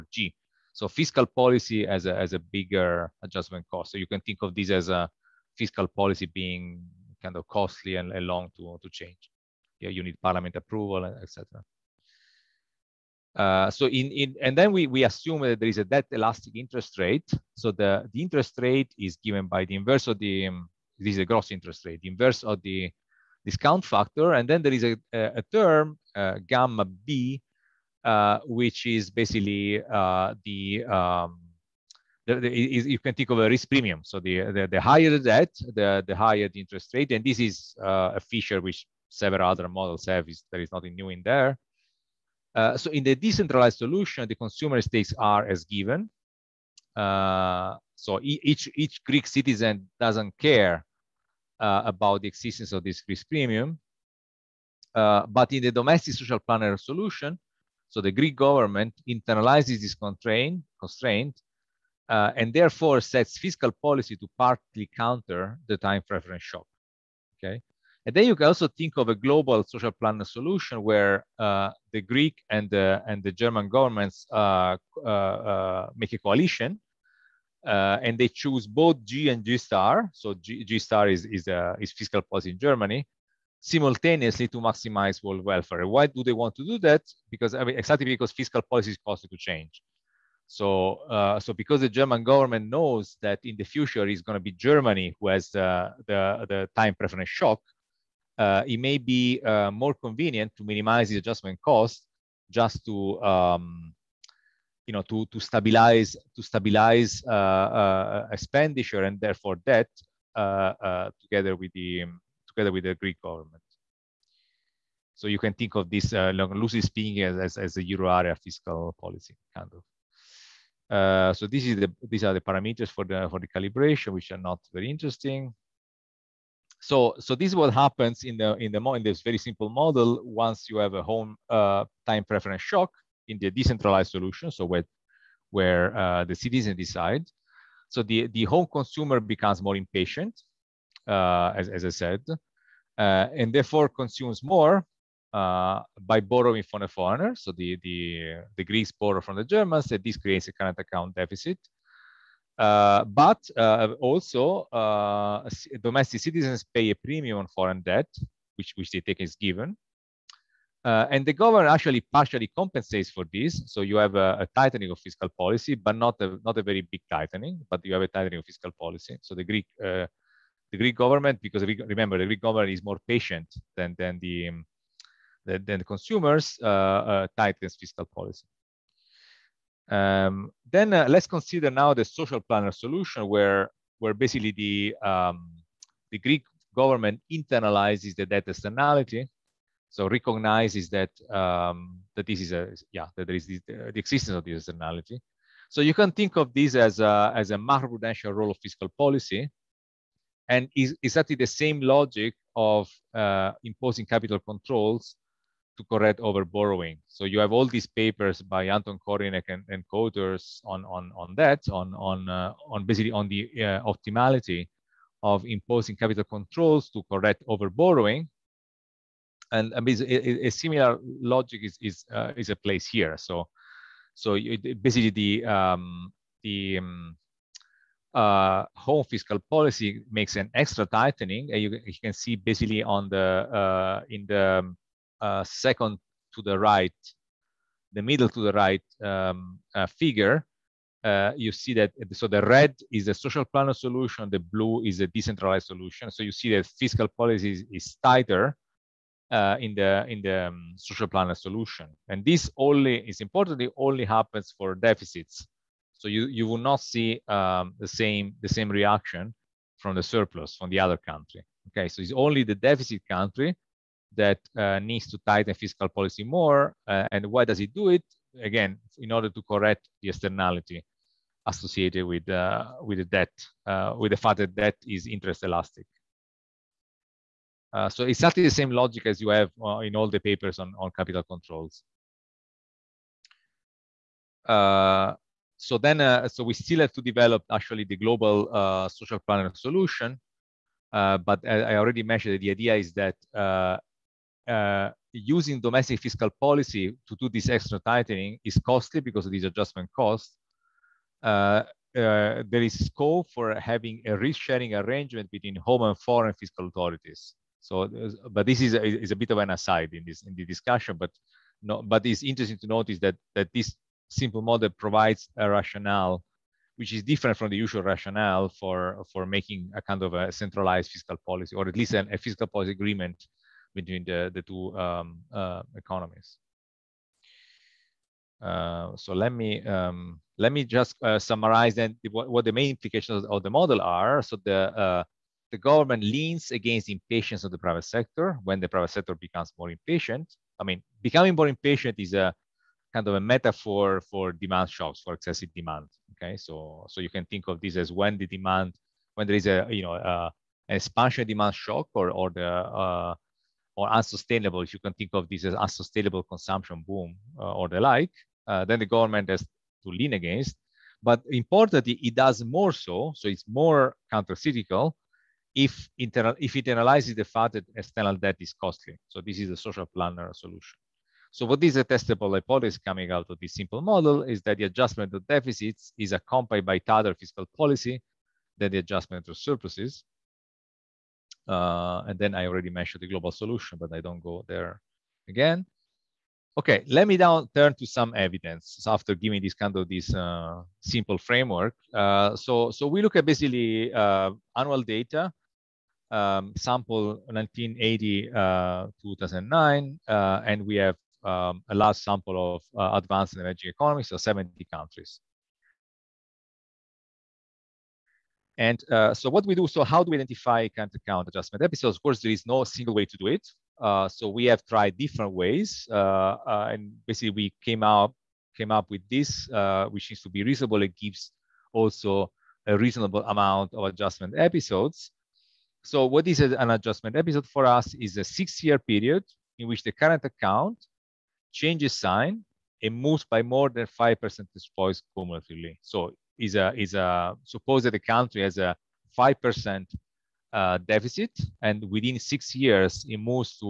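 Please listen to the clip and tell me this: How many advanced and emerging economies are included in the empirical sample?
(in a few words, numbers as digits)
70.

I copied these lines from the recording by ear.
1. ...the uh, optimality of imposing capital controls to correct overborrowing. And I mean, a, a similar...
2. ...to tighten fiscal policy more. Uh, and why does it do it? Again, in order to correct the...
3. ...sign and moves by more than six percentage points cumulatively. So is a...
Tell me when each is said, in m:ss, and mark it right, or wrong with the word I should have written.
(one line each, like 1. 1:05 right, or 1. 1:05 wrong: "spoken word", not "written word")
1. 3:33 right
2. 4:25 right
3. 7:11 wrong: "five", not "six".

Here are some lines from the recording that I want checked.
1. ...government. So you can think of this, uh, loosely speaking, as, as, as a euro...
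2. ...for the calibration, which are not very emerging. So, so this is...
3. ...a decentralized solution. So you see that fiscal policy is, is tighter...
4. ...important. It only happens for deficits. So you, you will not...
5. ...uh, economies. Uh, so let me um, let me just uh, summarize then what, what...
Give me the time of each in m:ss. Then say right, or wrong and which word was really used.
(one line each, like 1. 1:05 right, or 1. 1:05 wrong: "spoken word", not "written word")
1. 1:53 right
2. 2:03 wrong: "interesting", not "emerging"
3. 4:05 right
4. 4:13 right
5. 5:25 right.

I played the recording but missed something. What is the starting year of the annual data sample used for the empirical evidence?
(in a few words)
1980.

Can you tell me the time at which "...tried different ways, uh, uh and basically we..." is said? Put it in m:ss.
6:54.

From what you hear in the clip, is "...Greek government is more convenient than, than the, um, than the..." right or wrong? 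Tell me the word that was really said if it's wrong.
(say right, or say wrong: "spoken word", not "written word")
wrong: "patient", not "convenient".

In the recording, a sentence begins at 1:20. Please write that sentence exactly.
So G, G star is is is fiscal policy in Germany, simultaneously to maximize world welfare.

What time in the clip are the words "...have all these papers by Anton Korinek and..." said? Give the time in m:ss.
3:27.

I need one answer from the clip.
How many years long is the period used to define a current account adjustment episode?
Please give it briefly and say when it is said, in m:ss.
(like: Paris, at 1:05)
6, at 7:08.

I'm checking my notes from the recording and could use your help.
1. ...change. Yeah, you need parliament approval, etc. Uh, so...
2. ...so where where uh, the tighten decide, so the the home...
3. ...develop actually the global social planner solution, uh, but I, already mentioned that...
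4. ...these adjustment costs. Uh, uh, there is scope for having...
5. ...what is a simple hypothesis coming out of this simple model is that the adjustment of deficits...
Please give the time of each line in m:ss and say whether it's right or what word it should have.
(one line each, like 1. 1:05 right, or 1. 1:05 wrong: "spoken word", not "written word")
1. 0:08 right
2. 2:14 wrong: "citizen", not "tighten"
3. 4:47 right
4. 4:59 right
5. 6:11 wrong: "testable", not "simple".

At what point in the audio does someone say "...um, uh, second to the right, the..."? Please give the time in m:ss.
3:54.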